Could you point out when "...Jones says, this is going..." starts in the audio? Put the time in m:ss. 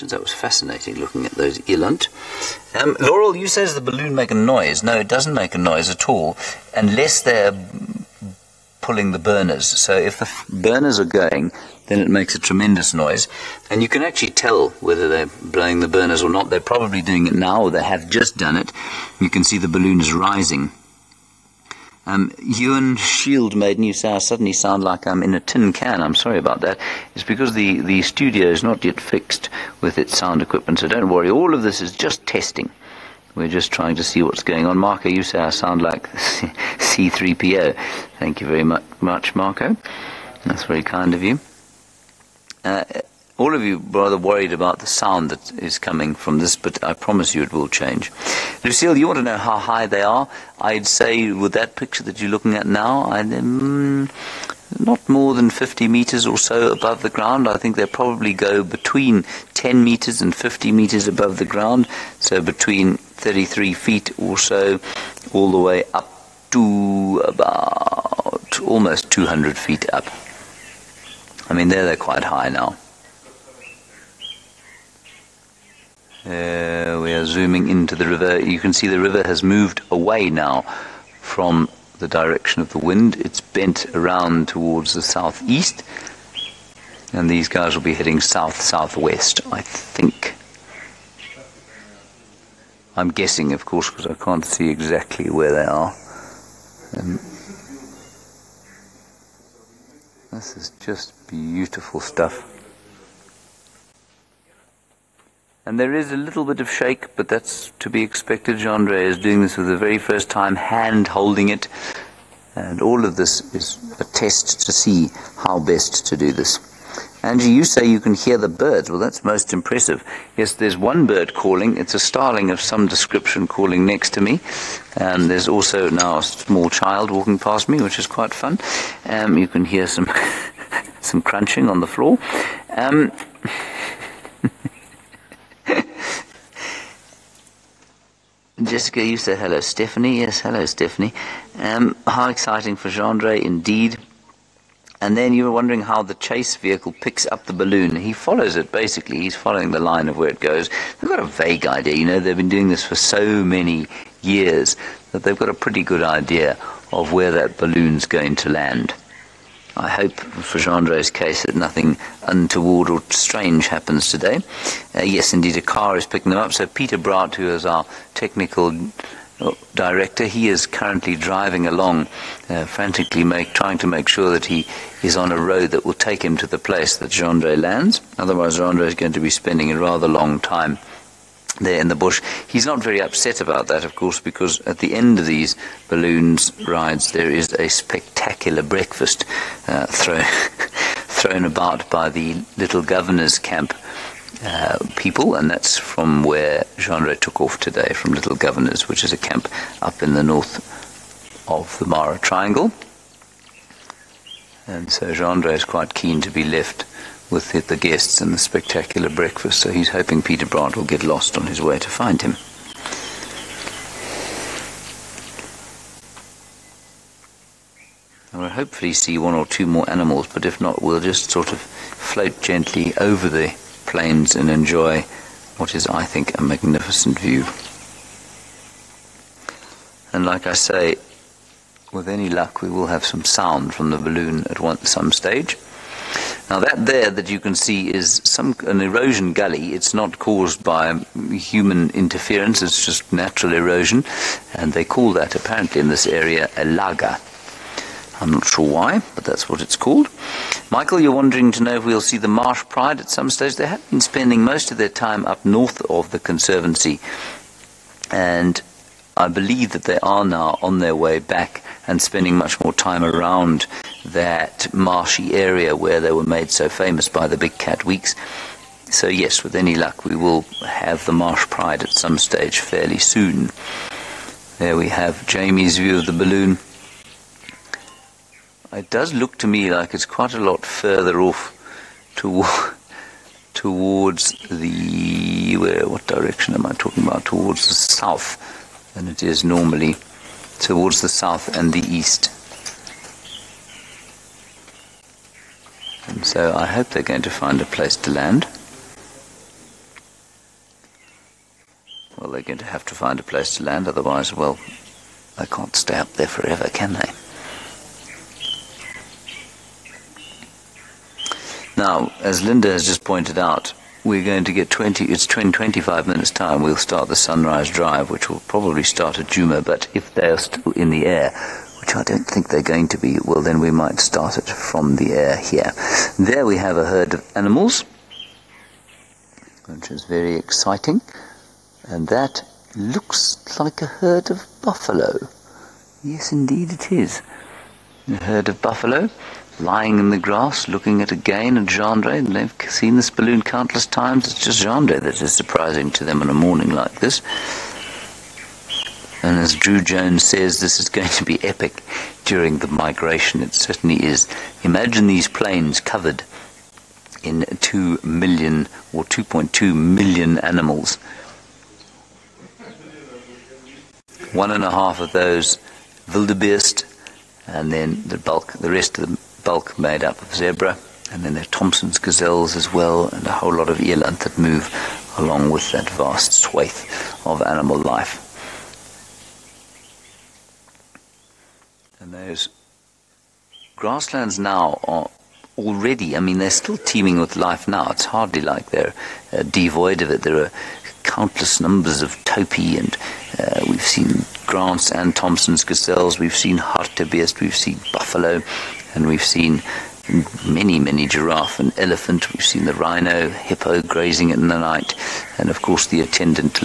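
5:49.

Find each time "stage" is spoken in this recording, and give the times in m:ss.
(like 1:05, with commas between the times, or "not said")
3:55, 4:13, 4:32.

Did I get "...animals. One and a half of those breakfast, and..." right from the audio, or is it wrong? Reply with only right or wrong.
wrong.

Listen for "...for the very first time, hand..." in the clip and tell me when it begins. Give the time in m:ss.
1:49.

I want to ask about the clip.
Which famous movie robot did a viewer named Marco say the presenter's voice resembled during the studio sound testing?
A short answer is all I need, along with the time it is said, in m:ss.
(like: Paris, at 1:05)
C3PO, at 0:36.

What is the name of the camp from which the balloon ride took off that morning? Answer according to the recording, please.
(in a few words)
Little Governors.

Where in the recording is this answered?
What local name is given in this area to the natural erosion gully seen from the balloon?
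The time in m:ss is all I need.
4:06.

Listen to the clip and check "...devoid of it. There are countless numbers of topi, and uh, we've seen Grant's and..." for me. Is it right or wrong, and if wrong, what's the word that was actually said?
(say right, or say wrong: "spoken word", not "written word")
right.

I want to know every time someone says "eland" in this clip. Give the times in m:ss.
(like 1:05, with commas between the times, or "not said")
0:01, 6:13.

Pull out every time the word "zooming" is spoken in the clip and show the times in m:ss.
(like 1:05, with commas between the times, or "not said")
1:17.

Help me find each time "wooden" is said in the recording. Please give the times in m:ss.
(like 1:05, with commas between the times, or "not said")
not said.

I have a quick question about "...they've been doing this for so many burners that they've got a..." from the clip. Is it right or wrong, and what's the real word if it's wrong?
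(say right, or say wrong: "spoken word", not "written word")
wrong: "years", not "burners".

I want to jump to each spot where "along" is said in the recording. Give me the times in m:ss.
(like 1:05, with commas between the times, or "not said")
2:51, 6:15.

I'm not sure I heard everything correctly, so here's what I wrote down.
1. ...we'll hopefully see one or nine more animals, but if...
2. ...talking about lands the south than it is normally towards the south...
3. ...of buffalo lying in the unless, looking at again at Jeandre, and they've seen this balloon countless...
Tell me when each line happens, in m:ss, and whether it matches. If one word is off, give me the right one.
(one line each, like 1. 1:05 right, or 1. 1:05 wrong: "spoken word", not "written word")
1. 3:38 wrong: "two", not "nine"
2. 4:46 wrong: "towards", not "lands"
3. 5:38 wrong: "grass", not "unless".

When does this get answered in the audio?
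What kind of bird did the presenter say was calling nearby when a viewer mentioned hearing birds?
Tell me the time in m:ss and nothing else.
2:01.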